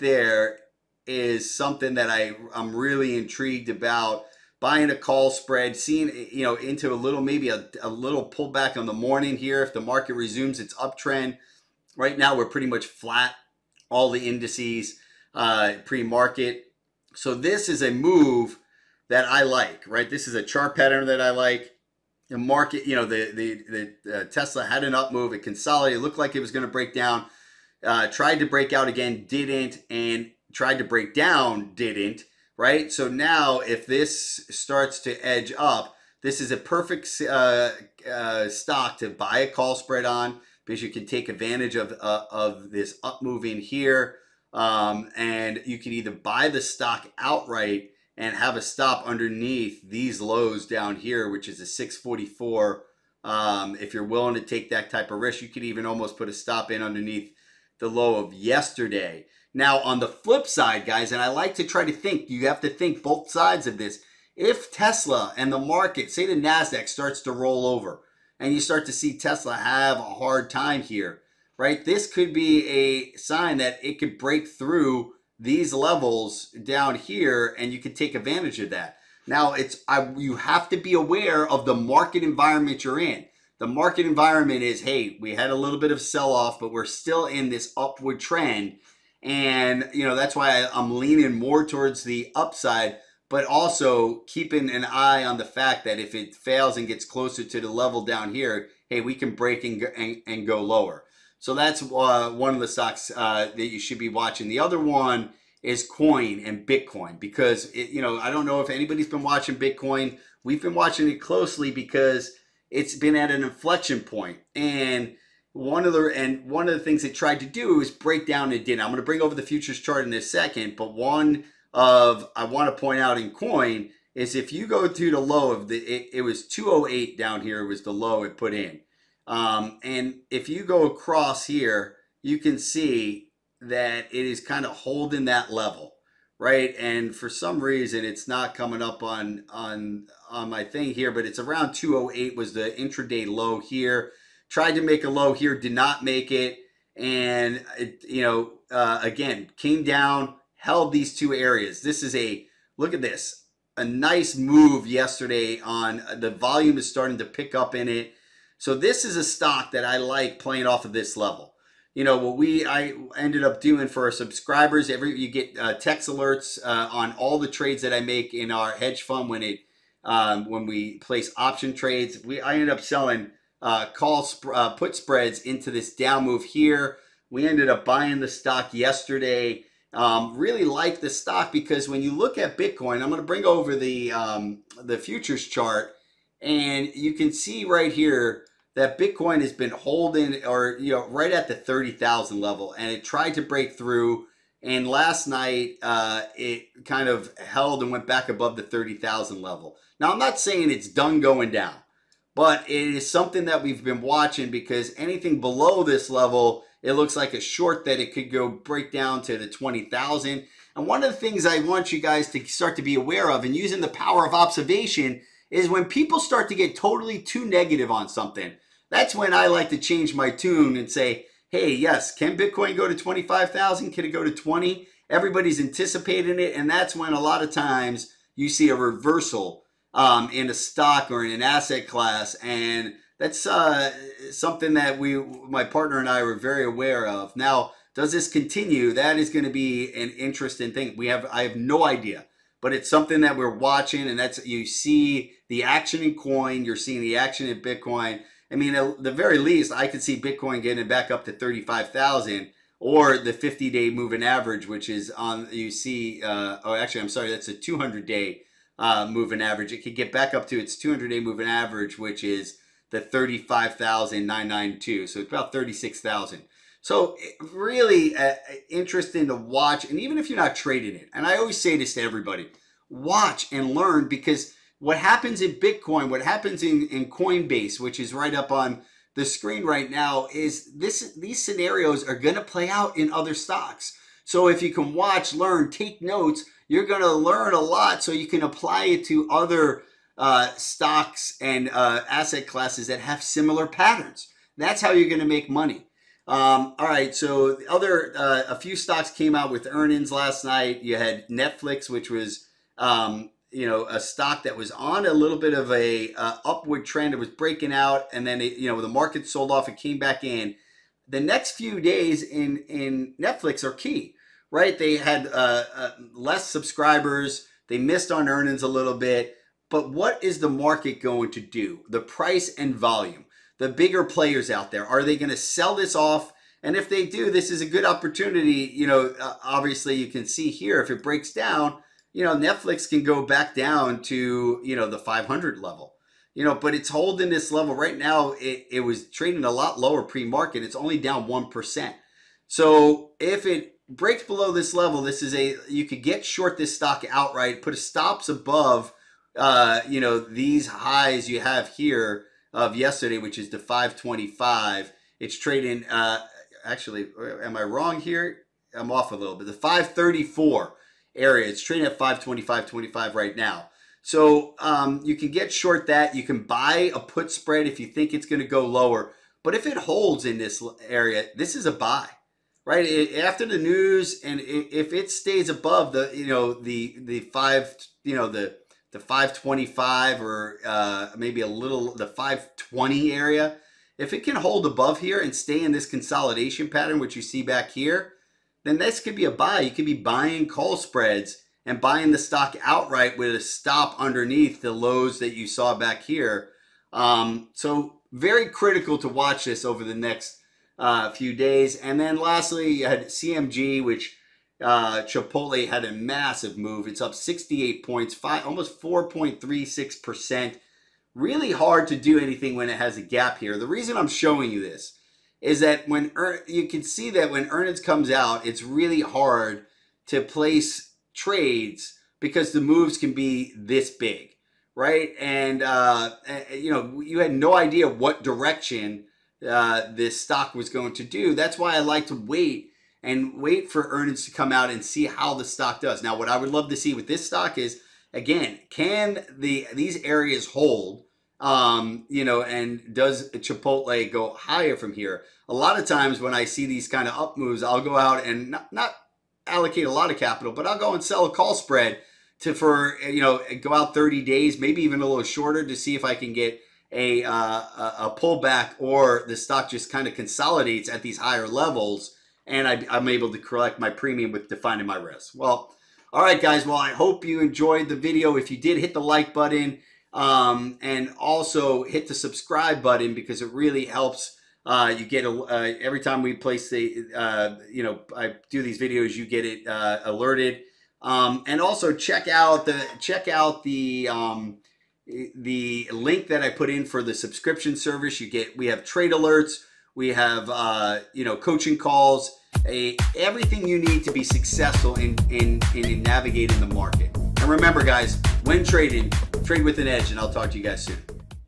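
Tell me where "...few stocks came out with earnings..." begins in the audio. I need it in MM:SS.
04:58.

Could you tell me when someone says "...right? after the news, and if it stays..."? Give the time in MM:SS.
06:12.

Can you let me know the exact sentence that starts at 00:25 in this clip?
It consolidated, looked like it was going to break down.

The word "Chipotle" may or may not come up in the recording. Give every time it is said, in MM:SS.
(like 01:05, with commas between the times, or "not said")
06:45, 07:23.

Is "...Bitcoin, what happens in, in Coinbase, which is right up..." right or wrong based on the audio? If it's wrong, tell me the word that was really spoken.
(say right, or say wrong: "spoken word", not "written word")
right.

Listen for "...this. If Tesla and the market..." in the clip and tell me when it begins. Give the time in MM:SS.
01:03.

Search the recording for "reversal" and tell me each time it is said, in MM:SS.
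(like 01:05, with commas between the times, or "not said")
03:48.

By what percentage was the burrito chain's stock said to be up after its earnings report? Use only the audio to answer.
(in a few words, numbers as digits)
4.36%.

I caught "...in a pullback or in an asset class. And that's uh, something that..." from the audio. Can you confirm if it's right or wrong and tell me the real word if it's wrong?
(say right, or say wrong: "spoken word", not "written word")
wrong: "stock", not "pullback".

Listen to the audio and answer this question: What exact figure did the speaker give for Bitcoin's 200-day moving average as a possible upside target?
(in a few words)
35,992.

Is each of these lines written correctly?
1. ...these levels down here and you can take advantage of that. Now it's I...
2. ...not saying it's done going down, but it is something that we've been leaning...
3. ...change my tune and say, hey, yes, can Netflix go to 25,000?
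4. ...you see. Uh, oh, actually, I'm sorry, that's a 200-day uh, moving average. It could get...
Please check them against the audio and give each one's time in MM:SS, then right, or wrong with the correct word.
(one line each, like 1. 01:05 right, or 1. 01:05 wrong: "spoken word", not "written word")
1. 01:15 right
2. 03:20 wrong: "watching", not "leaning"
3. 03:39 wrong: "Bitcoin", not "Netflix"
4. 04:15 right.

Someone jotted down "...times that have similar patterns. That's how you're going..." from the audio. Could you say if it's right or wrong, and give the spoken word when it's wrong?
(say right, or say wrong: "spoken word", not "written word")
wrong: "classes", not "times".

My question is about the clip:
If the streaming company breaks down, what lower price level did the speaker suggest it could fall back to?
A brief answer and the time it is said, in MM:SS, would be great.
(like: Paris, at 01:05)
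500, at 05:34.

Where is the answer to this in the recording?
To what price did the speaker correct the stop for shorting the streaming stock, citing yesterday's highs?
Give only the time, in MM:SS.
05:59.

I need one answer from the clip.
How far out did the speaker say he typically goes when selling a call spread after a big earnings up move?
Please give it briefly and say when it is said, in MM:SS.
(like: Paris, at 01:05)
30 days, at 07:33.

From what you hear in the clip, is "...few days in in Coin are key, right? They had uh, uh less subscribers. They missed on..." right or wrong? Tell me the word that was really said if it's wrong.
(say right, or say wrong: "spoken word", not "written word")
wrong: "Netflix", not "Coin".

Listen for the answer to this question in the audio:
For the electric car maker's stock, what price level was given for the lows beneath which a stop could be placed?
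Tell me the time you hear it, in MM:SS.
00:51.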